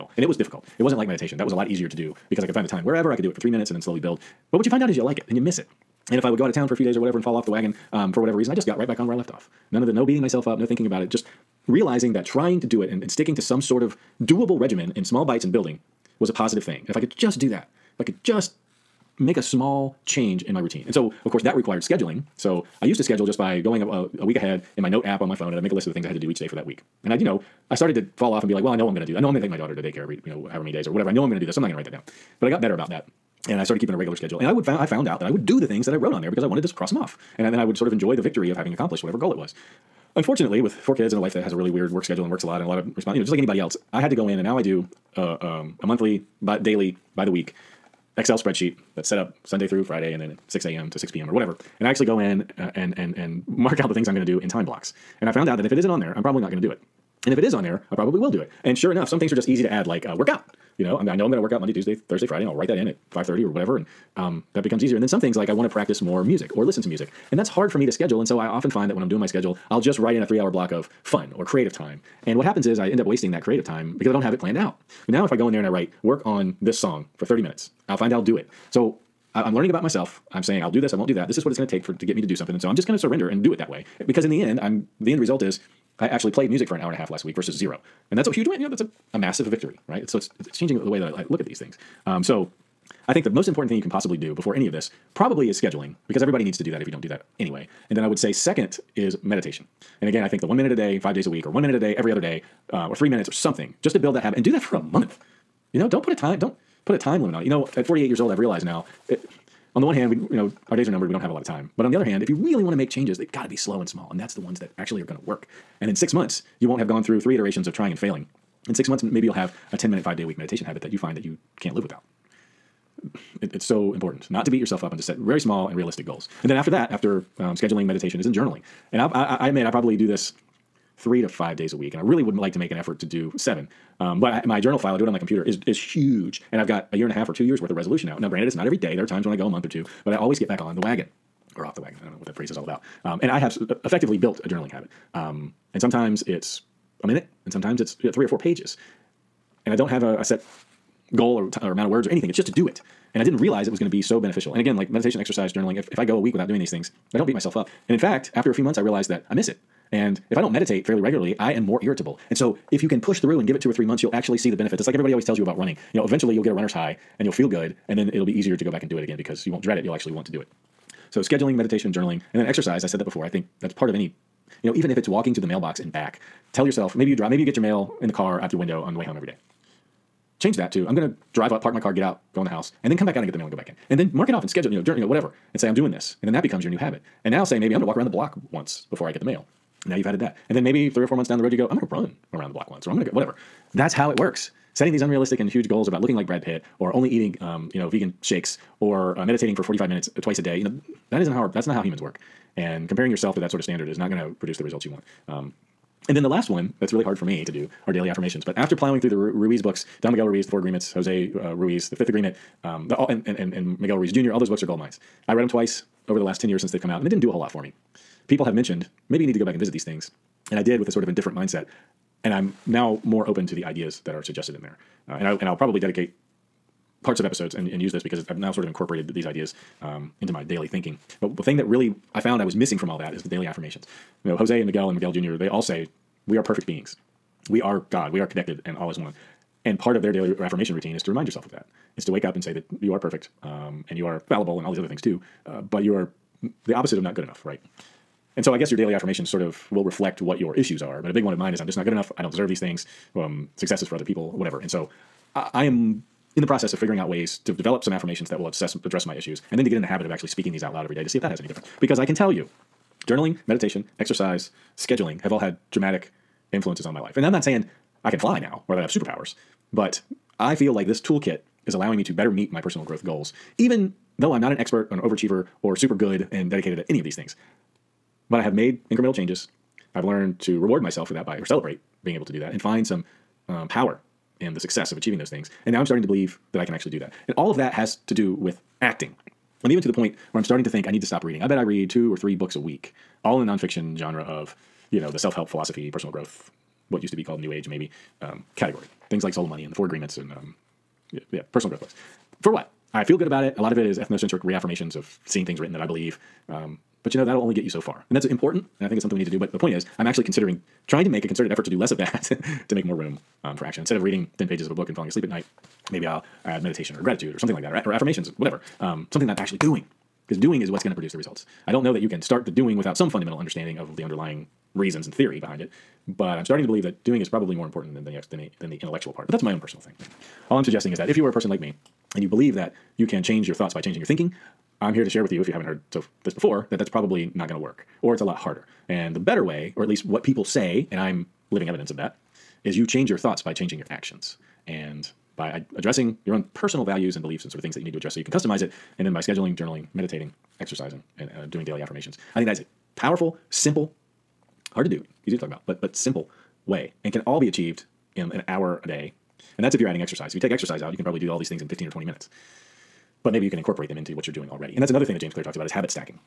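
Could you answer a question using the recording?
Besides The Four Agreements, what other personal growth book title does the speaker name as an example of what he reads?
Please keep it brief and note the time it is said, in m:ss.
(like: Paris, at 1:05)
Soul Money, at 4:59.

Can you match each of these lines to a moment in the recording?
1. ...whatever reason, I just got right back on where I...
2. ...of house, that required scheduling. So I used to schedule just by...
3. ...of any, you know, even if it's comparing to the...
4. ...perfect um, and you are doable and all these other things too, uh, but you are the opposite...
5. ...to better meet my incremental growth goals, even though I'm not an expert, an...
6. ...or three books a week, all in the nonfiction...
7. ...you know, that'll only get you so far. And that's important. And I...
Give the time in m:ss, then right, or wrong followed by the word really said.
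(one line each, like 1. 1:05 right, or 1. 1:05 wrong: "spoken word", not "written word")
1. 0:08 right
2. 0:21 wrong: "course", not "house"
3. 2:53 wrong: "walking", not "comparing"
4. 4:02 wrong: "fallible", not "doable"
5. 4:32 wrong: "personal", not "incremental"
6. 4:52 right
7. 5:07 right.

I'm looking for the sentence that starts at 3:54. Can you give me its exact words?
You know, Jose and Miguel and Miguel Jr.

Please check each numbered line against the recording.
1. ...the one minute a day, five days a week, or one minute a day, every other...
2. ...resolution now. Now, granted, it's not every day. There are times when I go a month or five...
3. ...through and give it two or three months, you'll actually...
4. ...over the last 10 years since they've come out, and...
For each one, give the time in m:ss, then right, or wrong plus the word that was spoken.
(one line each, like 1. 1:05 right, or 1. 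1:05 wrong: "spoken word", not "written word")
1. 1:40 right
2. 2:17 wrong: "two", not "five"
3. 2:43 right
4. 3:36 right.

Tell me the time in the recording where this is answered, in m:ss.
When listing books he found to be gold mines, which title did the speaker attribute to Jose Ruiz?
3:31.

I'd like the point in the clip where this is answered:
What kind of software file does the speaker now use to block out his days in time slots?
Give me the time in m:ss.
0:48.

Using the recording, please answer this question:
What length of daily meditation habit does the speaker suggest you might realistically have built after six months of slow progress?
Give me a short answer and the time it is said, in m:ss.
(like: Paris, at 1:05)
10 minute, at 1:59.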